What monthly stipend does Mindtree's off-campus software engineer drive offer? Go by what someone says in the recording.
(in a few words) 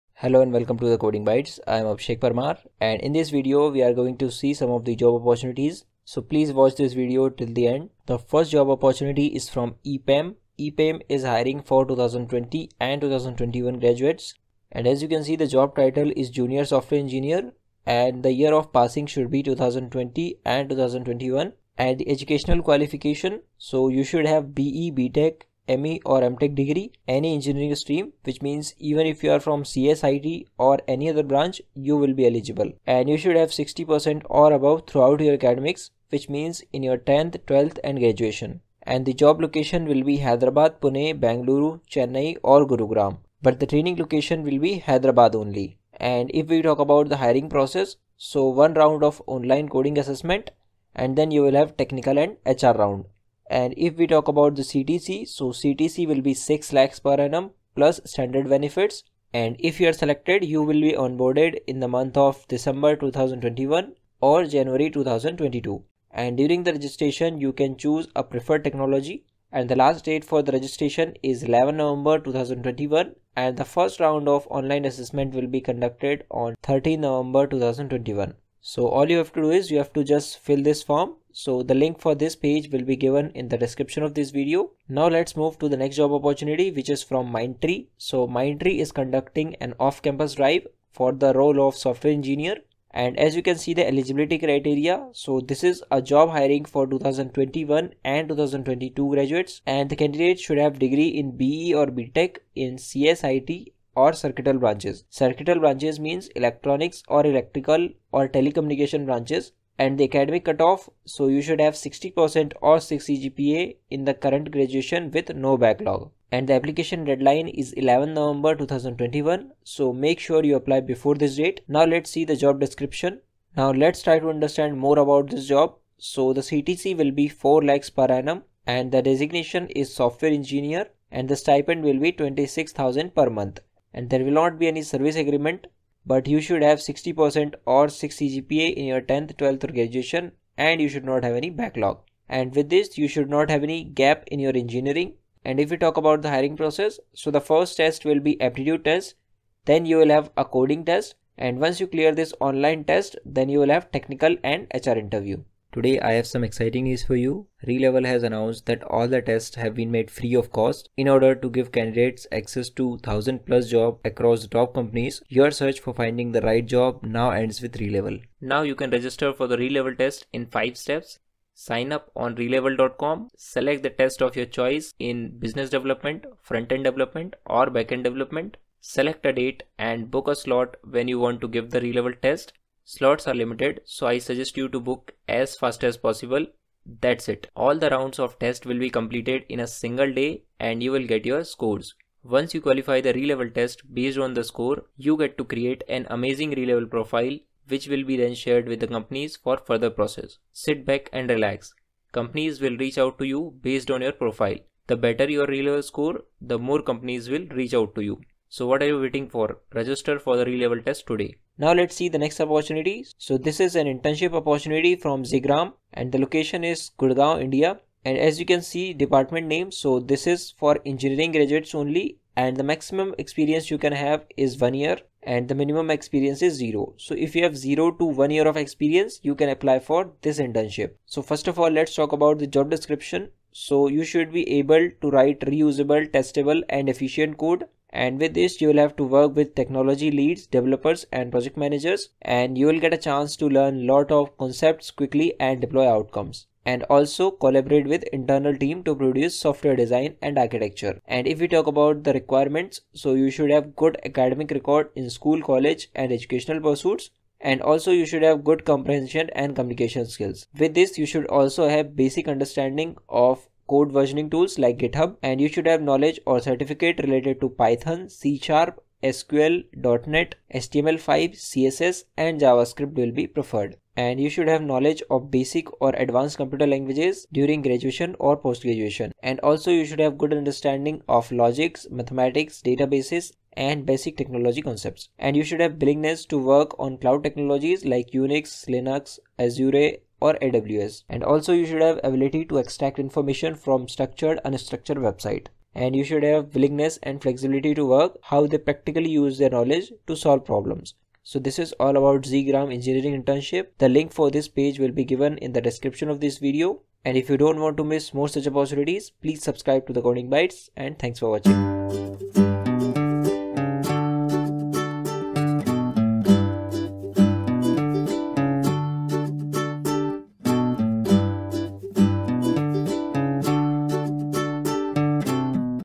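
26,000 per month.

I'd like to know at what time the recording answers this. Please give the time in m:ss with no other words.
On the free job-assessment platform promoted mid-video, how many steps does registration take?
2:50.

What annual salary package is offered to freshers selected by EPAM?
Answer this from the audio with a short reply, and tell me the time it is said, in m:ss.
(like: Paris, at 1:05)
6 lakhs per annum, at 0:56.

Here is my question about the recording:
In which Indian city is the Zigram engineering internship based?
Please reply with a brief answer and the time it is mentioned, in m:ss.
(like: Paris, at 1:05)
Gurgaon, at 3:36.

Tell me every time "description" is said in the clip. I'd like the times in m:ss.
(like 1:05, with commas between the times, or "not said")
1:23, 2:02, 3:52, 5:05.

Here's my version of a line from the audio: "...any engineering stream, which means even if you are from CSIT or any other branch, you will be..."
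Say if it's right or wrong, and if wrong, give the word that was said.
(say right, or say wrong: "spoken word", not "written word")
right.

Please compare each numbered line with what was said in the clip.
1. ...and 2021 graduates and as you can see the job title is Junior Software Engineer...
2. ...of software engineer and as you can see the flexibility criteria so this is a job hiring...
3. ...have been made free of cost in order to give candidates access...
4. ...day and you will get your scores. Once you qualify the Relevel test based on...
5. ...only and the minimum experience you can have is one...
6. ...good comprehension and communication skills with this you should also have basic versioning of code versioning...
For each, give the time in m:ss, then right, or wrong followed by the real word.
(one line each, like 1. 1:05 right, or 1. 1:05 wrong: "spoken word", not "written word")
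1. 0:12 right
2. 1:31 wrong: "eligibility", not "flexibility"
3. 2:39 right
4. 3:10 right
5. 3:41 wrong: "maximum", not "minimum"
6. 4:18 wrong: "understanding", not "versioning".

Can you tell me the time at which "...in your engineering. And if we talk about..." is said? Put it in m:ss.
2:24.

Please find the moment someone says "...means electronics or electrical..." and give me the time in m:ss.
1:45.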